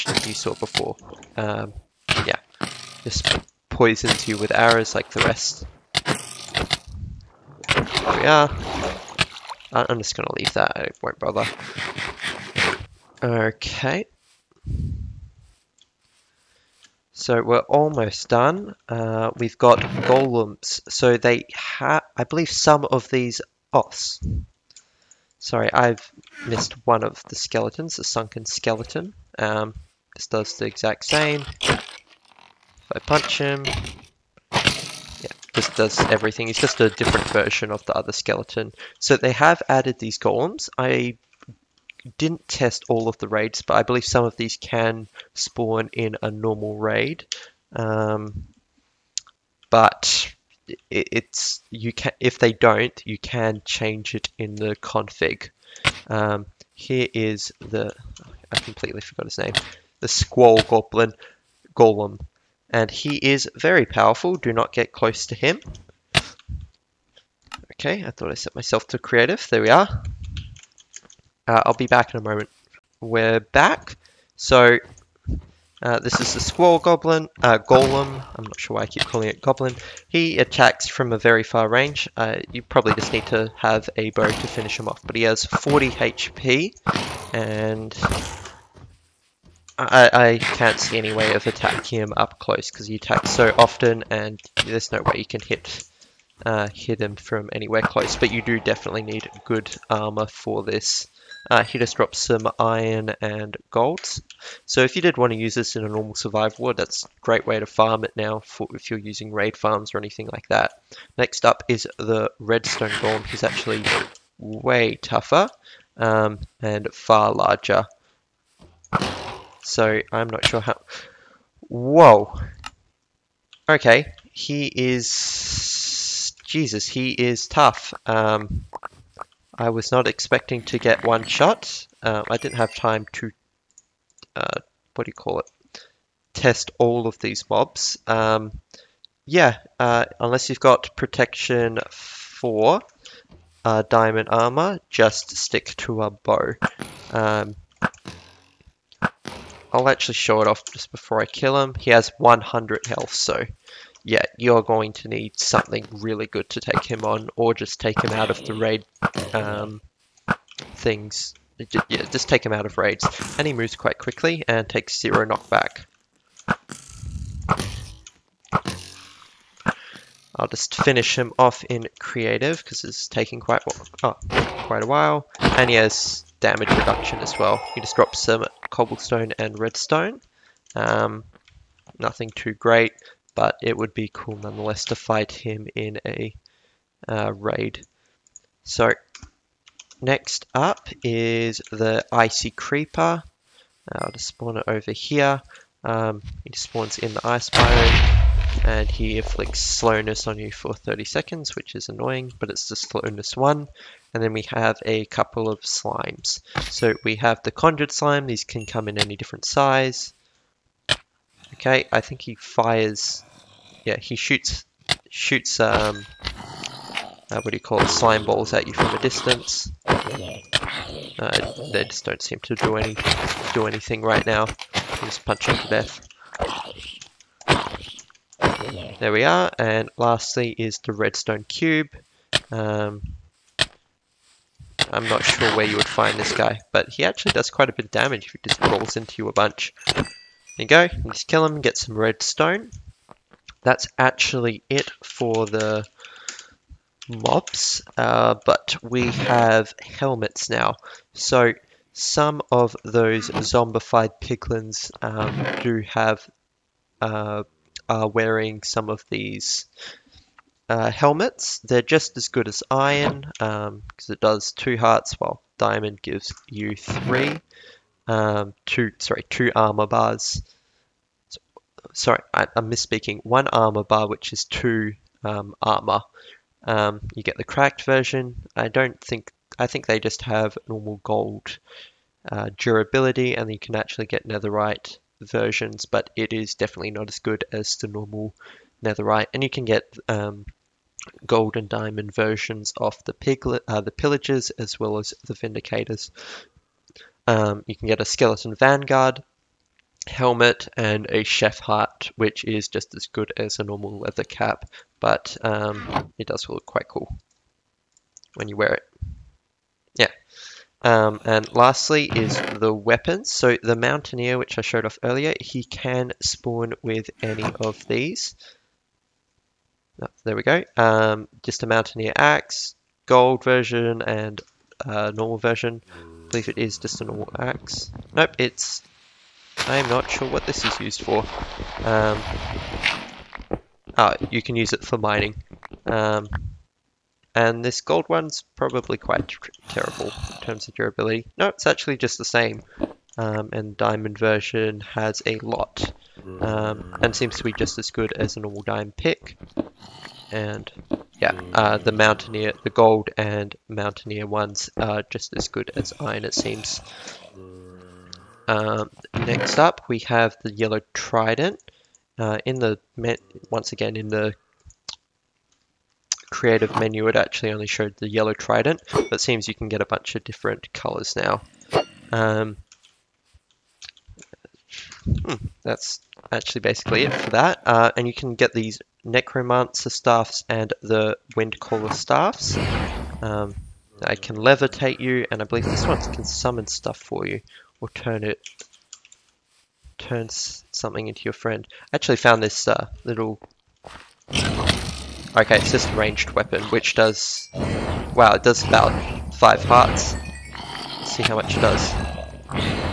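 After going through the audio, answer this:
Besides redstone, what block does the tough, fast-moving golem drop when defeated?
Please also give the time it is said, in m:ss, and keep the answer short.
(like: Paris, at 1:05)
Cobblestone, at 2:58.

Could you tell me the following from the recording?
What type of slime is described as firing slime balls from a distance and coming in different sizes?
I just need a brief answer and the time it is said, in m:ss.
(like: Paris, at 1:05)
Conjured slime, at 3:27.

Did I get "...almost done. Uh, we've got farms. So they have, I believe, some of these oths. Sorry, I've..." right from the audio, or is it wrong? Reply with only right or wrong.
wrong.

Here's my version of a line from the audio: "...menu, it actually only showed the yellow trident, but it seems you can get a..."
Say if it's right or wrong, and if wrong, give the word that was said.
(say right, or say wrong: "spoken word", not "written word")
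right.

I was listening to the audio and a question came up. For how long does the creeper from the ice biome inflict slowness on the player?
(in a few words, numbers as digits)
30 seconds.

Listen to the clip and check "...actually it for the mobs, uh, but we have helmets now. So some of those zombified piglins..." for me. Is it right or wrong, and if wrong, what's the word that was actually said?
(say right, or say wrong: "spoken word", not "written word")
right.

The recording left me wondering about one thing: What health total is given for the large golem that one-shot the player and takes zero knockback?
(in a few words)
100.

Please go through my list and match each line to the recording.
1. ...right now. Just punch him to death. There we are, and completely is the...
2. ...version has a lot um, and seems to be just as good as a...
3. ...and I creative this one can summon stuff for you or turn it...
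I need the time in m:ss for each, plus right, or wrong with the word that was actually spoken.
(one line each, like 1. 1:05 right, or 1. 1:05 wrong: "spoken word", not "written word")
1. 3:44 wrong: "lastly", not "completely"
2. 5:44 right
3. 6:25 wrong: "believe", not "creative".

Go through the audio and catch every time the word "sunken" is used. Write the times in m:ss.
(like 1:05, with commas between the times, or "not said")
0:28.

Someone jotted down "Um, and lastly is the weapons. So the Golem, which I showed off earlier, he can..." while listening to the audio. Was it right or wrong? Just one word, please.
wrong.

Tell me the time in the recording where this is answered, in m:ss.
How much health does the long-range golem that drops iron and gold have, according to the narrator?
1:25.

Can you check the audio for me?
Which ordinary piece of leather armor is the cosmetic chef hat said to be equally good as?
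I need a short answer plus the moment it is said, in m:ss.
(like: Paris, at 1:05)
Leather cap, at 5:04.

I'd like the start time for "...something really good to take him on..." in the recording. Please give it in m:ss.
2:35.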